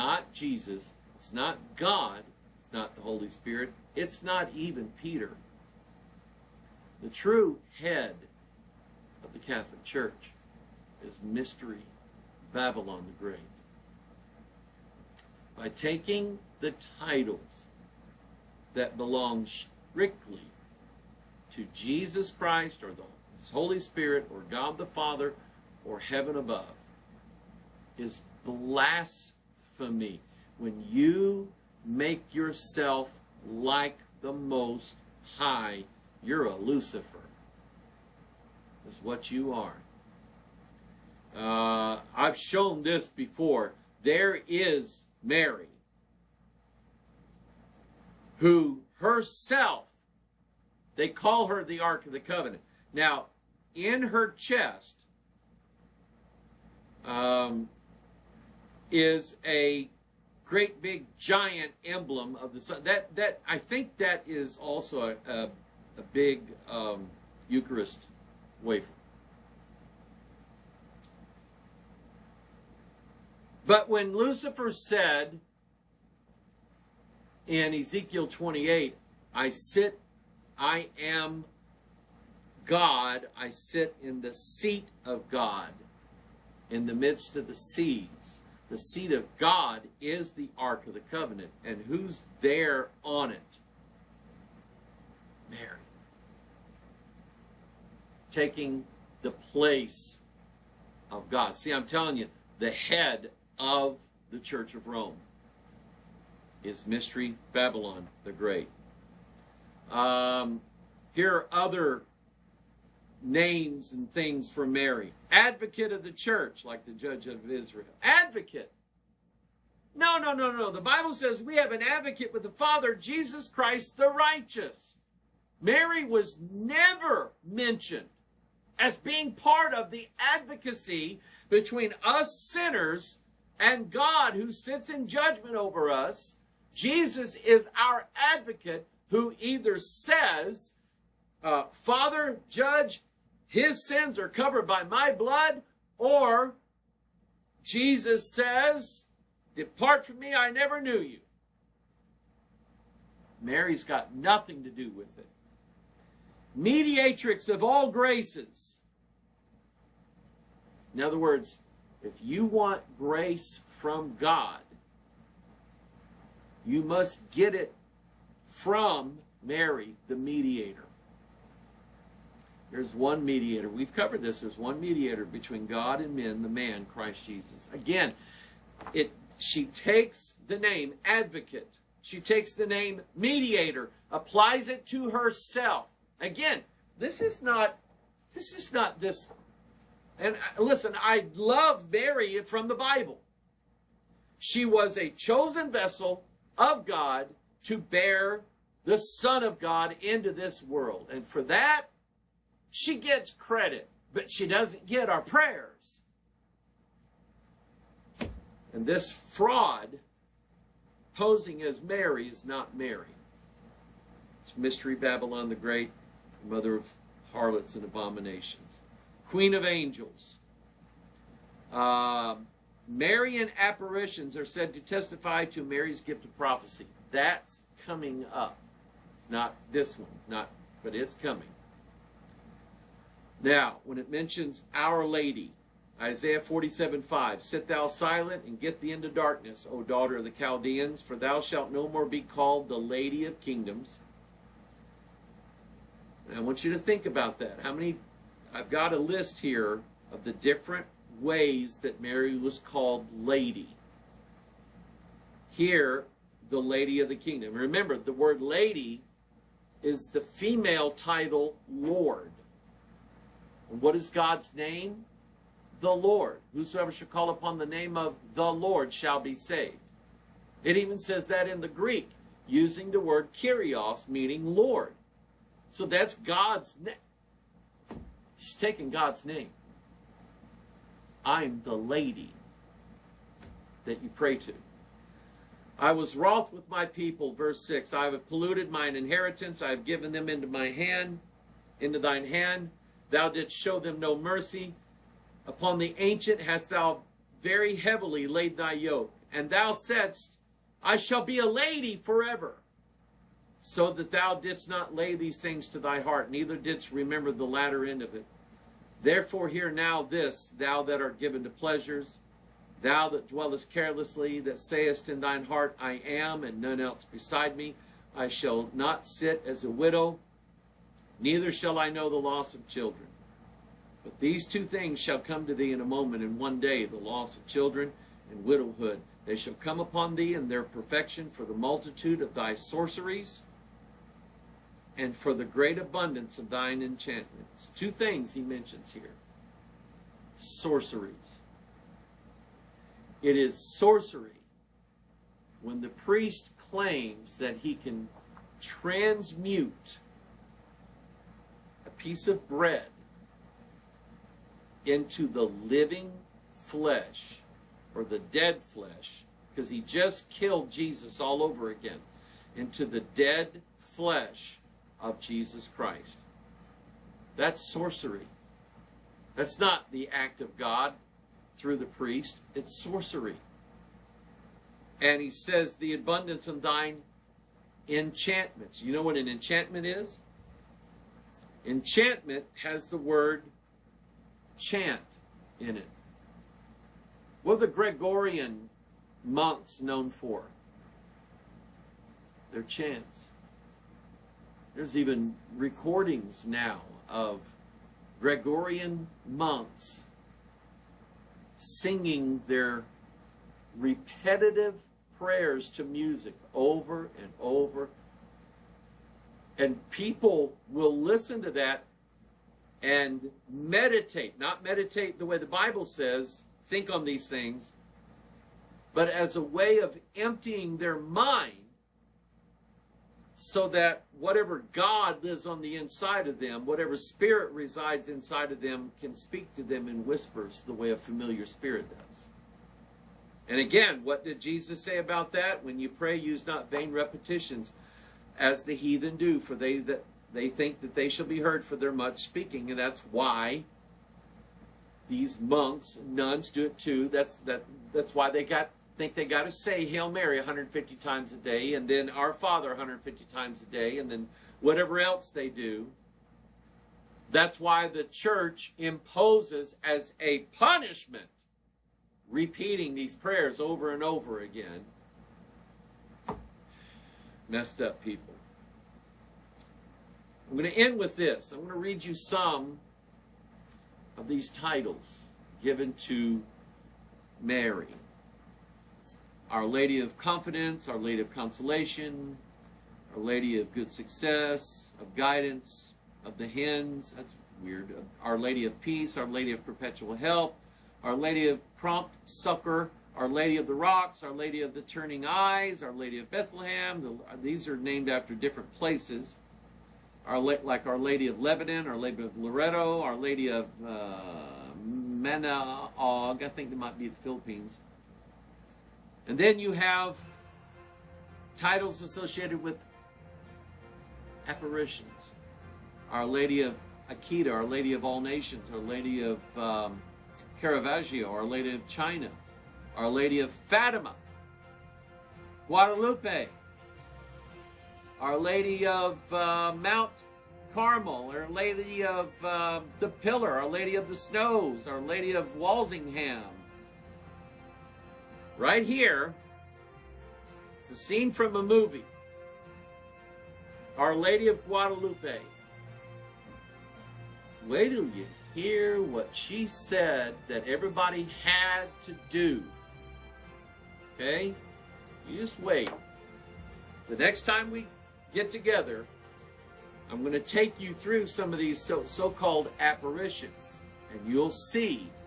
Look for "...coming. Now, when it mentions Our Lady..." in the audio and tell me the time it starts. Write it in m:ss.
3:51.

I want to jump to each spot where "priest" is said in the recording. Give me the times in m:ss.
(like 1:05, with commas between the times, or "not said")
5:45, 6:11.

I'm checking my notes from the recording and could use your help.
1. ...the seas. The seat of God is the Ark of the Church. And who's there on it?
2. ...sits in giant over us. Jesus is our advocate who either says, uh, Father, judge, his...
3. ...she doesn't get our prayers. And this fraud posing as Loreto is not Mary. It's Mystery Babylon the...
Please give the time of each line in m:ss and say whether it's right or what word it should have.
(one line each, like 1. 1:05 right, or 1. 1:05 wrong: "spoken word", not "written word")
1. 1:27 wrong: "Covenant", not "Church"
2. 2:14 wrong: "judgment", not "giant"
3. 3:24 wrong: "Mary", not "Loreto".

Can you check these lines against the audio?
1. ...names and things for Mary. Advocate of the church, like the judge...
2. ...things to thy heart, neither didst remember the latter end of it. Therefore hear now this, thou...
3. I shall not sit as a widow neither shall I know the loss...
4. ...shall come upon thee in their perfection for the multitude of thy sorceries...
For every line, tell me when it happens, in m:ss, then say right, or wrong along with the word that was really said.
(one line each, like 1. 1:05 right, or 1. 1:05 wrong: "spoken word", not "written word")
1. 1:53 right
2. 5:05 right
3. 5:18 right
4. 5:29 right.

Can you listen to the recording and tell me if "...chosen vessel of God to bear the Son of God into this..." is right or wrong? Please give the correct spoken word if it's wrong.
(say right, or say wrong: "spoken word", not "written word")
right.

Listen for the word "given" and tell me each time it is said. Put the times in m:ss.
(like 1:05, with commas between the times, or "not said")
4:49, 5:11, 7:55.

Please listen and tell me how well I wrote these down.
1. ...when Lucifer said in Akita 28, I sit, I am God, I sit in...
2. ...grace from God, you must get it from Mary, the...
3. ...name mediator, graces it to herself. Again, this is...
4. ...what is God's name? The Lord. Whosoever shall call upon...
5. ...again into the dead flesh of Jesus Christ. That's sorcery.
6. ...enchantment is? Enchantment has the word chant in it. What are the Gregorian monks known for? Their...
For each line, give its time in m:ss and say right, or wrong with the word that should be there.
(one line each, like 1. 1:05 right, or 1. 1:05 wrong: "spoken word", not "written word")
1. 1:13 wrong: "Ezekiel", not "Akita"
2. 2:42 right
3. 3:02 wrong: "applies", not "graces"
4. 4:23 right
5. 6:01 right
6. 6:19 right.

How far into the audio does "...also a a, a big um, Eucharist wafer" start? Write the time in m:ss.
1:04.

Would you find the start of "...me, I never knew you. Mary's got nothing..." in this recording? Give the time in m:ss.
2:30.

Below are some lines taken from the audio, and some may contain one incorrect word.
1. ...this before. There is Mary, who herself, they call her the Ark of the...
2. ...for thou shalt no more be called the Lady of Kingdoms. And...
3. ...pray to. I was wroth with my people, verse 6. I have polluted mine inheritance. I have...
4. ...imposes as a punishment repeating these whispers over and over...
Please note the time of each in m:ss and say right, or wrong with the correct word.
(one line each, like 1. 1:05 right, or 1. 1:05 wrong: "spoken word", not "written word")
1. 0:42 right
2. 4:01 right
3. 4:44 right
4. 7:38 wrong: "prayers", not "whispers".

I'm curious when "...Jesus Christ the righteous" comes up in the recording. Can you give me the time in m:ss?
2:02.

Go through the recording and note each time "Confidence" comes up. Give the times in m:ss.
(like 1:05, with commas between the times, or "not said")
8:00.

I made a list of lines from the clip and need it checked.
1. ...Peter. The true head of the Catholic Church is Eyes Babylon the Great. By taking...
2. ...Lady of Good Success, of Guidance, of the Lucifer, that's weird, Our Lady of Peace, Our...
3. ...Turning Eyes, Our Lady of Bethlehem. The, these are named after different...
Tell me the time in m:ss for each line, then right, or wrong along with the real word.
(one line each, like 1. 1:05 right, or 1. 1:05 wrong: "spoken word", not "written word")
1. 0:04 wrong: "Mystery", not "Eyes"
2. 8:03 wrong: "Hens", not "Lucifer"
3. 8:14 right.